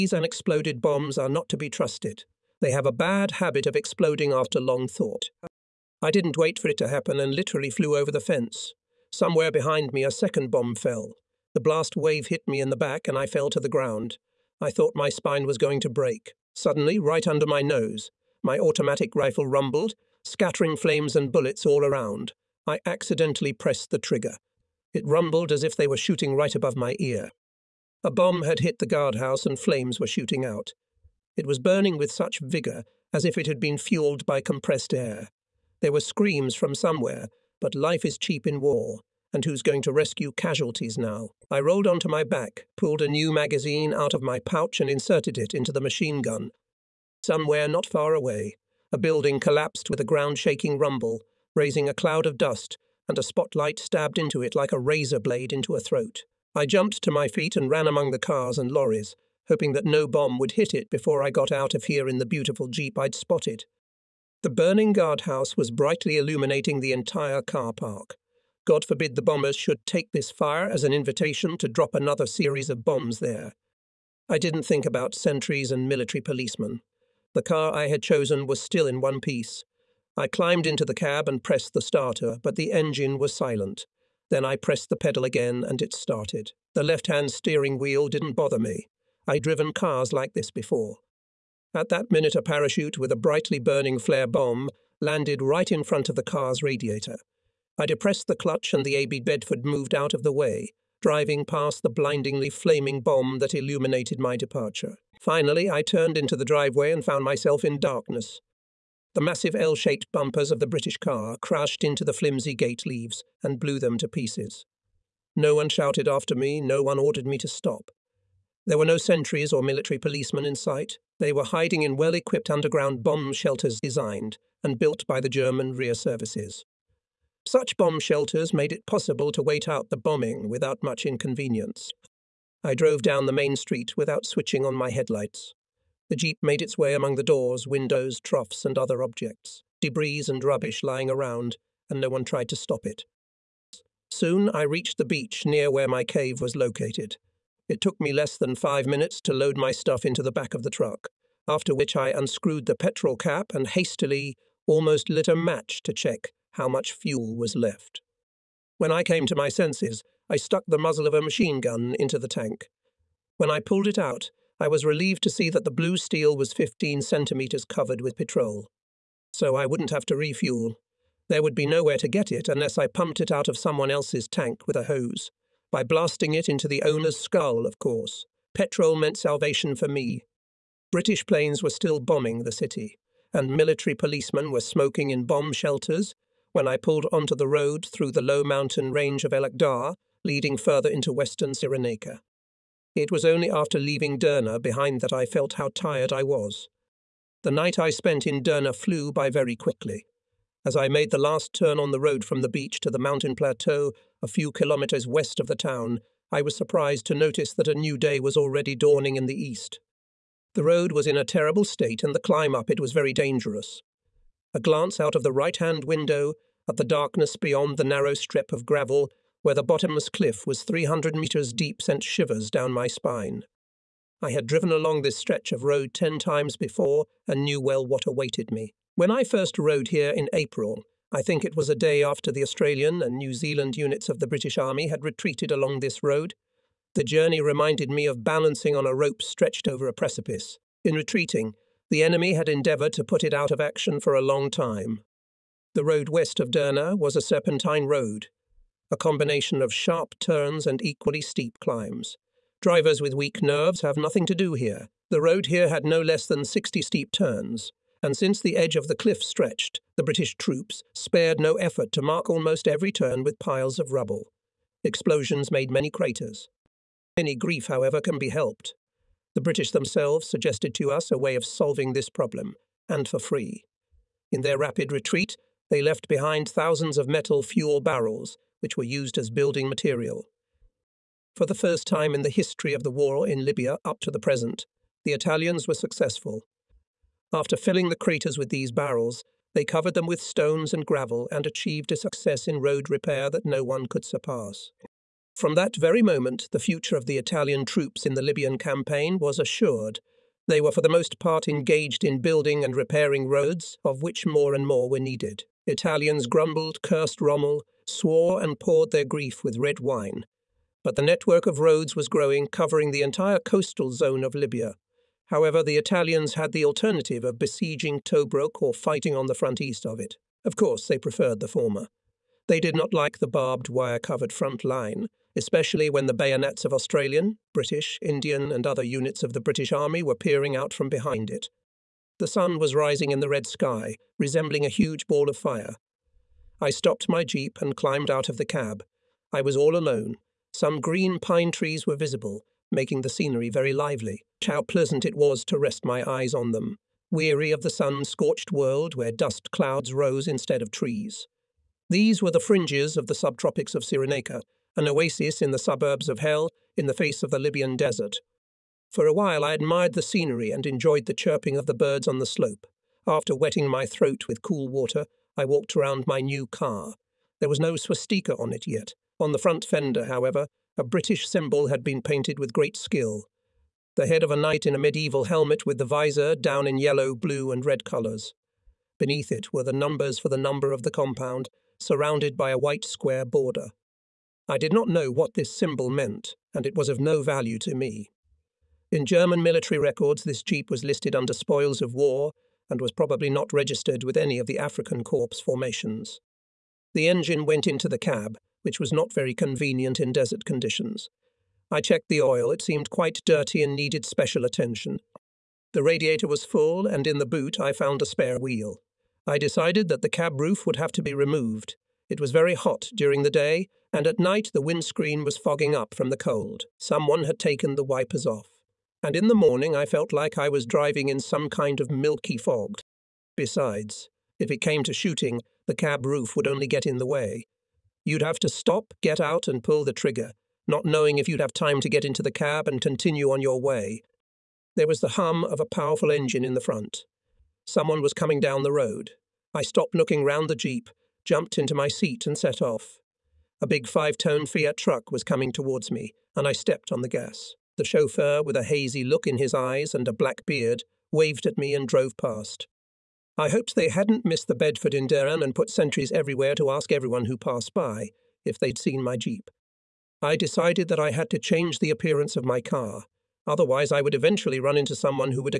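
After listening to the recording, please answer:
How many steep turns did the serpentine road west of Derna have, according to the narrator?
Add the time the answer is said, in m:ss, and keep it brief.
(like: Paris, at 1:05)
60, at 4:16.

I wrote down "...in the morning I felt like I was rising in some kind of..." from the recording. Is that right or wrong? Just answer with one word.
wrong.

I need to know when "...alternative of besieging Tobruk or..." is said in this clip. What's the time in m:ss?
5:16.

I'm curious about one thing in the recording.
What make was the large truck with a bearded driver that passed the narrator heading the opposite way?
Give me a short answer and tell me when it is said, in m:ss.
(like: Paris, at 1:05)
Fiat, at 7:24.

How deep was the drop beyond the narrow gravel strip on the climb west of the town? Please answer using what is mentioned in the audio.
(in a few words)
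300 metres.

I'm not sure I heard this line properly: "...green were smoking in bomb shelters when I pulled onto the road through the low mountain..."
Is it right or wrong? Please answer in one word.
wrong.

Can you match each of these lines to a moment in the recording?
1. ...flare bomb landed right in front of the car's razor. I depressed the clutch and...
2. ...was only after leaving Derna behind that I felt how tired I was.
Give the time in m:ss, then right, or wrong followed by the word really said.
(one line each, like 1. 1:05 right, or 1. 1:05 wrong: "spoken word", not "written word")
1. 1:33 wrong: "radiator", not "razor"
2. 3:13 right.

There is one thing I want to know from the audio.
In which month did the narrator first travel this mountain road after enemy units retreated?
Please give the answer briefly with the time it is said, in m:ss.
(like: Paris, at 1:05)
April, at 3:50.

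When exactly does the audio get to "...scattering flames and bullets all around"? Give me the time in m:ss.
0:20.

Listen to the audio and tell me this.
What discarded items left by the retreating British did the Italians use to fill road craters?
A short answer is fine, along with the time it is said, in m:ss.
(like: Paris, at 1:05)
metal fuel barrels, at 4:37.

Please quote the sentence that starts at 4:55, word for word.
From that very moment, the future of the Italian troops in the Libyan campaign was assured.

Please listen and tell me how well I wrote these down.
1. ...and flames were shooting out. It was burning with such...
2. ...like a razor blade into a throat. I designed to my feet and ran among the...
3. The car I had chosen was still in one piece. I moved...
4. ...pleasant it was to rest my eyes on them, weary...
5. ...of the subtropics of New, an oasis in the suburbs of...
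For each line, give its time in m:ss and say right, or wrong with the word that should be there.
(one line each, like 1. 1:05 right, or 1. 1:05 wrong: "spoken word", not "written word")
1. 0:29 right
2. 0:54 wrong: "jumped", not "designed"
3. 1:17 wrong: "climbed", not "moved"
4. 5:44 right
5. 5:52 wrong: "Cyrenaica", not "New".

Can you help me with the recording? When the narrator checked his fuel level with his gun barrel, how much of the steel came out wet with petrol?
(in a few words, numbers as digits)
15 centimetres.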